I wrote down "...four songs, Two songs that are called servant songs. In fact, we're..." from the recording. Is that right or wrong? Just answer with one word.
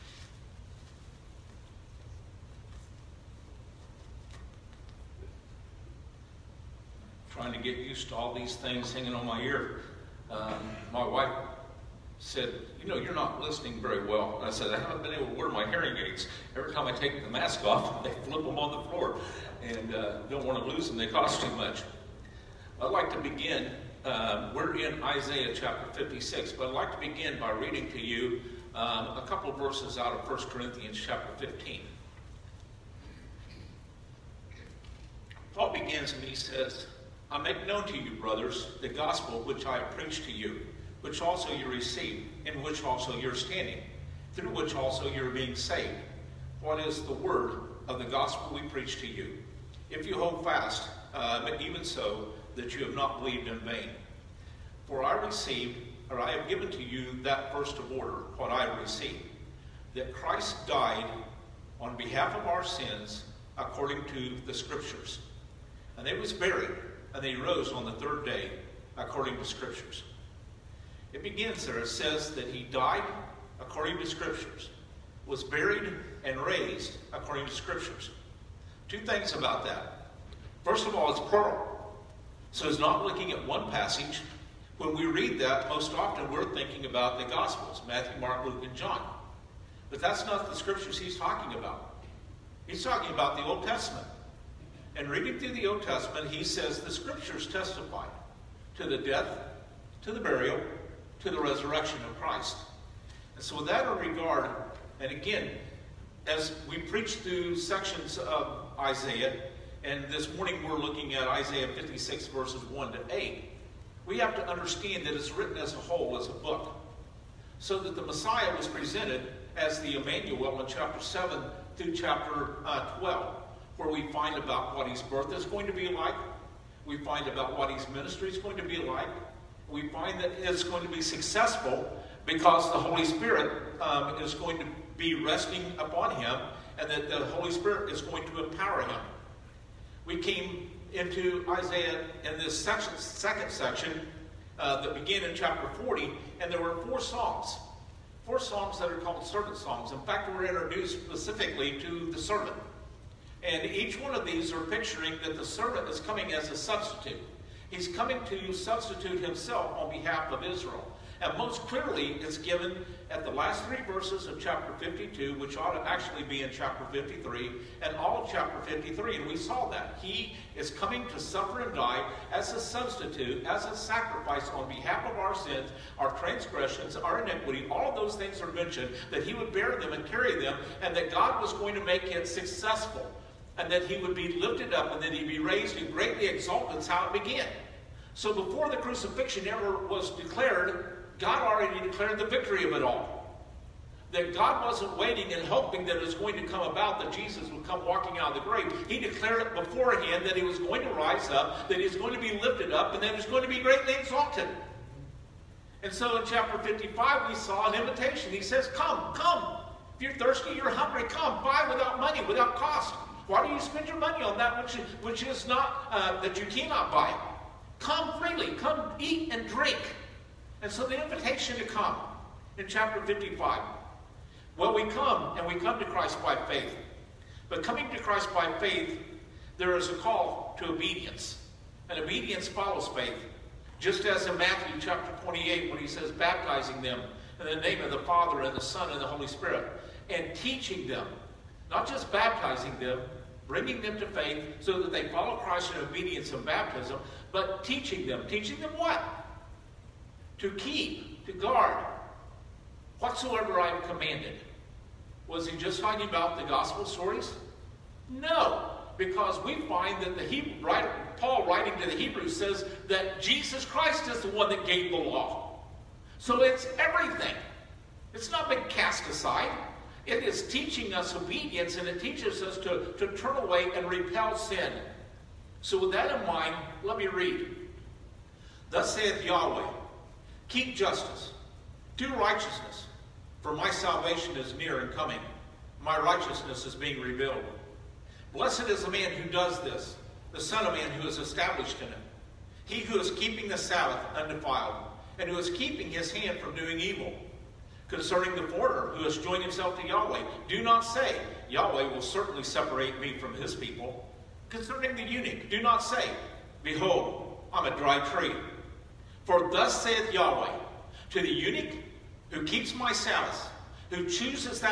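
wrong.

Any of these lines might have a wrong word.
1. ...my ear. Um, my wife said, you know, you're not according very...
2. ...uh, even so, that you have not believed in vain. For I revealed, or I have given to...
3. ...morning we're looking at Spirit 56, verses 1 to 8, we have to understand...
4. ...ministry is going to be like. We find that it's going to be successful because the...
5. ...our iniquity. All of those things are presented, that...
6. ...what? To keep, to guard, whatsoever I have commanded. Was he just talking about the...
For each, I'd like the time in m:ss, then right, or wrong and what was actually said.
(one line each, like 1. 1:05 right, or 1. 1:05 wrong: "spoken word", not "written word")
1. 0:09 wrong: "listening", not "according"
2. 0:51 wrong: "received", not "revealed"
3. 1:50 wrong: "Isaiah", not "Spirit"
4. 2:07 right
5. 2:56 wrong: "mentioned", not "presented"
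6. 4:08 right.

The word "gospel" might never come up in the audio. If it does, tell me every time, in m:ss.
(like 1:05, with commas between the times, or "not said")
0:38, 0:48, 1:27, 4:16.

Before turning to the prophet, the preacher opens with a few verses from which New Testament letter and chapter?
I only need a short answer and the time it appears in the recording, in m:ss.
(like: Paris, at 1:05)
1 Corinthians 15, at 0:30.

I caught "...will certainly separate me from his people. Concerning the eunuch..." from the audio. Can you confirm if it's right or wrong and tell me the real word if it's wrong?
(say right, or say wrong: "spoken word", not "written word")
right.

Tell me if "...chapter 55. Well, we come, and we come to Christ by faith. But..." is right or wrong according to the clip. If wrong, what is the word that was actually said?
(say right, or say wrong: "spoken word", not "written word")
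right.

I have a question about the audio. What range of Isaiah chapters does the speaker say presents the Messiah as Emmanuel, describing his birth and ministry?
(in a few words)
Chapters 7 through 12.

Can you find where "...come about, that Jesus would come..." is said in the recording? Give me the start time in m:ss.
3:16.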